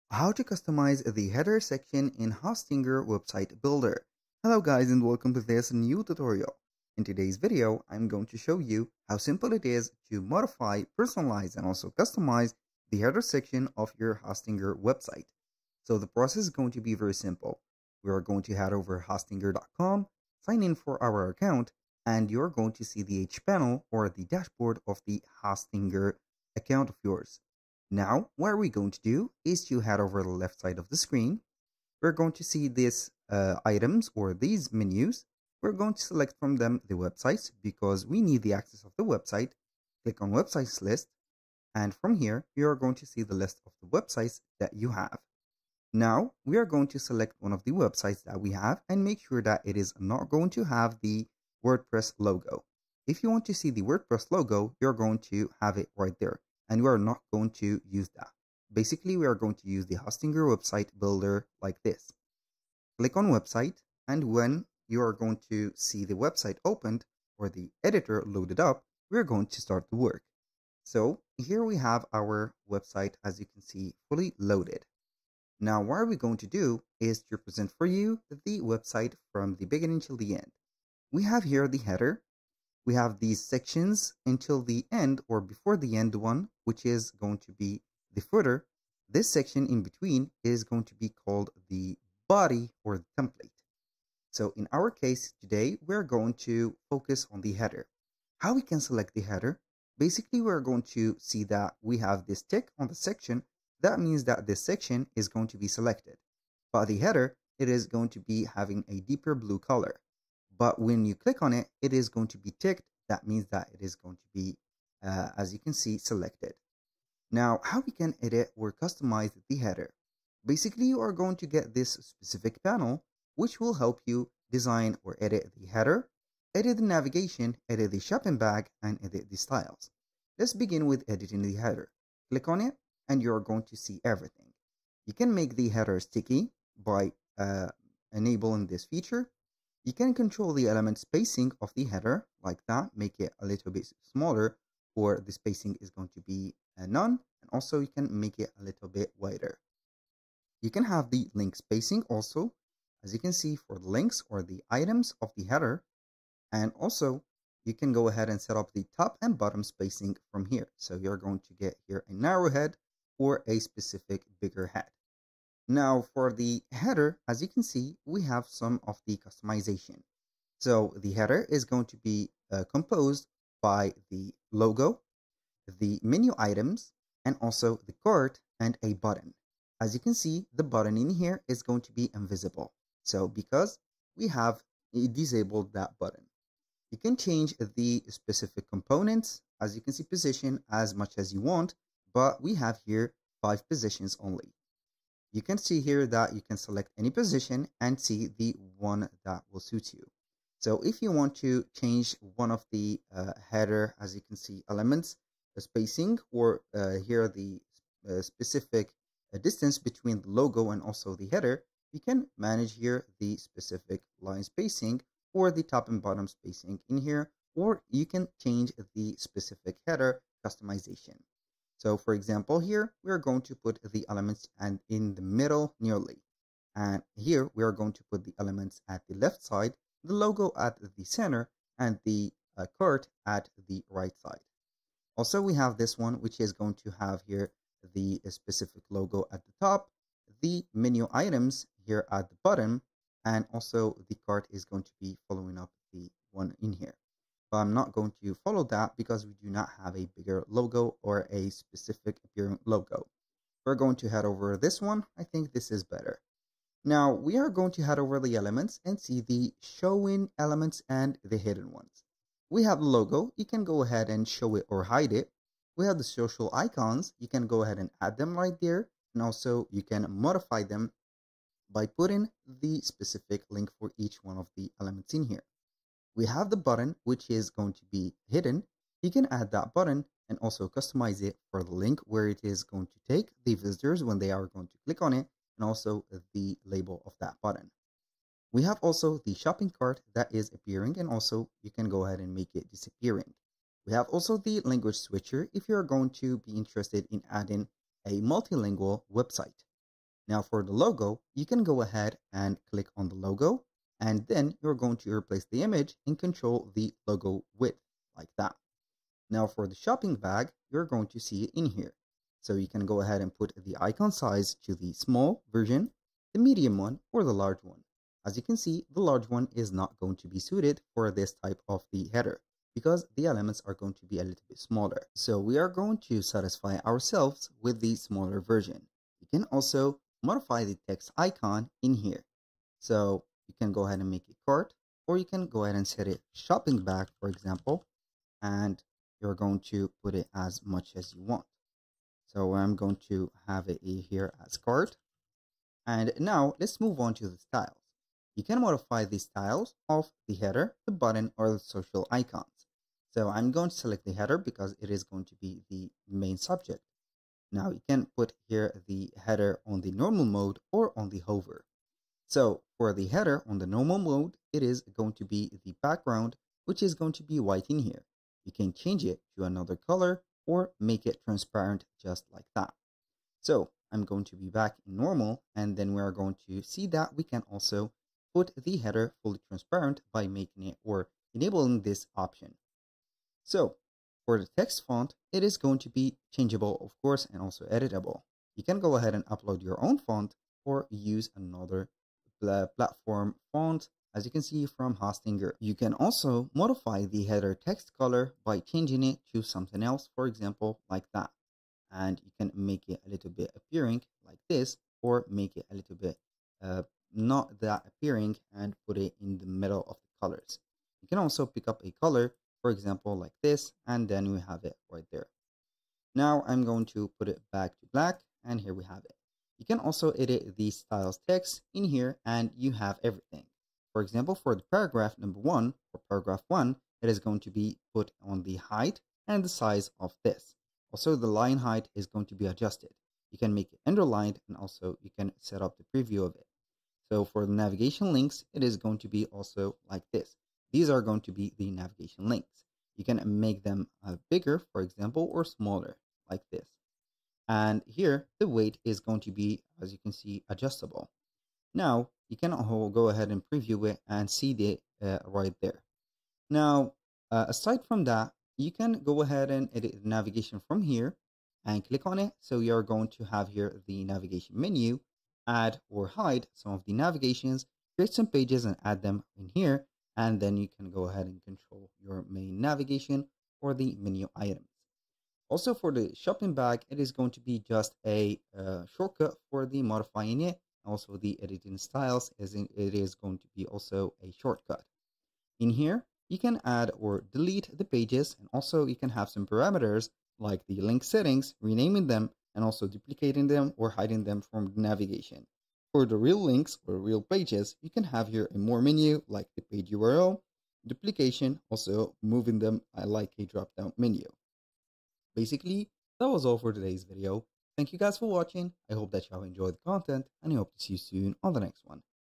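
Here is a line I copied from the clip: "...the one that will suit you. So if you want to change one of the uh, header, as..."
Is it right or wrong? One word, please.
right.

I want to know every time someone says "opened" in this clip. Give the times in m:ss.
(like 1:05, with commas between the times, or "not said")
1:06.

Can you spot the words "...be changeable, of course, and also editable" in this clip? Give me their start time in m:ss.
6:25.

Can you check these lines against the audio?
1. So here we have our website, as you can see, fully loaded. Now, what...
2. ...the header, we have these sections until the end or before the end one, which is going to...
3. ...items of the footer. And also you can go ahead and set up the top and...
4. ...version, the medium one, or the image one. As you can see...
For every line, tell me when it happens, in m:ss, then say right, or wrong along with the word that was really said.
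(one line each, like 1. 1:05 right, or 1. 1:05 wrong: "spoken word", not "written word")
1. 1:10 right
2. 1:21 right
3. 2:34 wrong: "header", not "footer"
4. 5:15 wrong: "large", not "image".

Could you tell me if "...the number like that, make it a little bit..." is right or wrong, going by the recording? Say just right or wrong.
wrong.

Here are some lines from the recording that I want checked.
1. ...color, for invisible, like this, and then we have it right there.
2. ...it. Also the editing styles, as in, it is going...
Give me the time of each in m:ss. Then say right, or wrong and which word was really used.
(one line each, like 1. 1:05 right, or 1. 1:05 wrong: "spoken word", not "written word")
1. 6:52 wrong: "example", not "invisible"
2. 8:00 right.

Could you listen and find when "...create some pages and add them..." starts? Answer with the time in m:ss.
7:47.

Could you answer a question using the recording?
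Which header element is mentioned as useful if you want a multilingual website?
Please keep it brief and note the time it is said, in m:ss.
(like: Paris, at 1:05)
Language switcher, at 4:54.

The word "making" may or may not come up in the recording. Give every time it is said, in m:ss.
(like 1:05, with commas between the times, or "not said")
6:20.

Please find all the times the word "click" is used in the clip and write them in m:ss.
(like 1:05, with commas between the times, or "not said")
0:40, 1:02, 1:51, 2:12, 4:44, 5:02, 7:41.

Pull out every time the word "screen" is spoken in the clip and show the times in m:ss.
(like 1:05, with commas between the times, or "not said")
0:30.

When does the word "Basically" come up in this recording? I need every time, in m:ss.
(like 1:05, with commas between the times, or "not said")
0:58, 1:39, 2:00, 8:25.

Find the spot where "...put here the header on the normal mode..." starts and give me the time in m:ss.
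5:58.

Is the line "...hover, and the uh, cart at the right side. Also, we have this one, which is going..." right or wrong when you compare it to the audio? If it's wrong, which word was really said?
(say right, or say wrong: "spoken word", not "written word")
wrong: "center", not "hover".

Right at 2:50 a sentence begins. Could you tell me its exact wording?
So the header is going to be uh, composed by the logo, the menu items, and also the cart and a button.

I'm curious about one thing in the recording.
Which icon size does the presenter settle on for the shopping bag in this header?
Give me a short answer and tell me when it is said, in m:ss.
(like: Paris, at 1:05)
Small, at 5:27.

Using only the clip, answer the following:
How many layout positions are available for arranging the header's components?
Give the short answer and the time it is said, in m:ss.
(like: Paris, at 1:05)
5, at 3:13.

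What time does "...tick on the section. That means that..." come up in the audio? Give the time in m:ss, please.
1:42.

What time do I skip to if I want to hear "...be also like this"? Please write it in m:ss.
7:19.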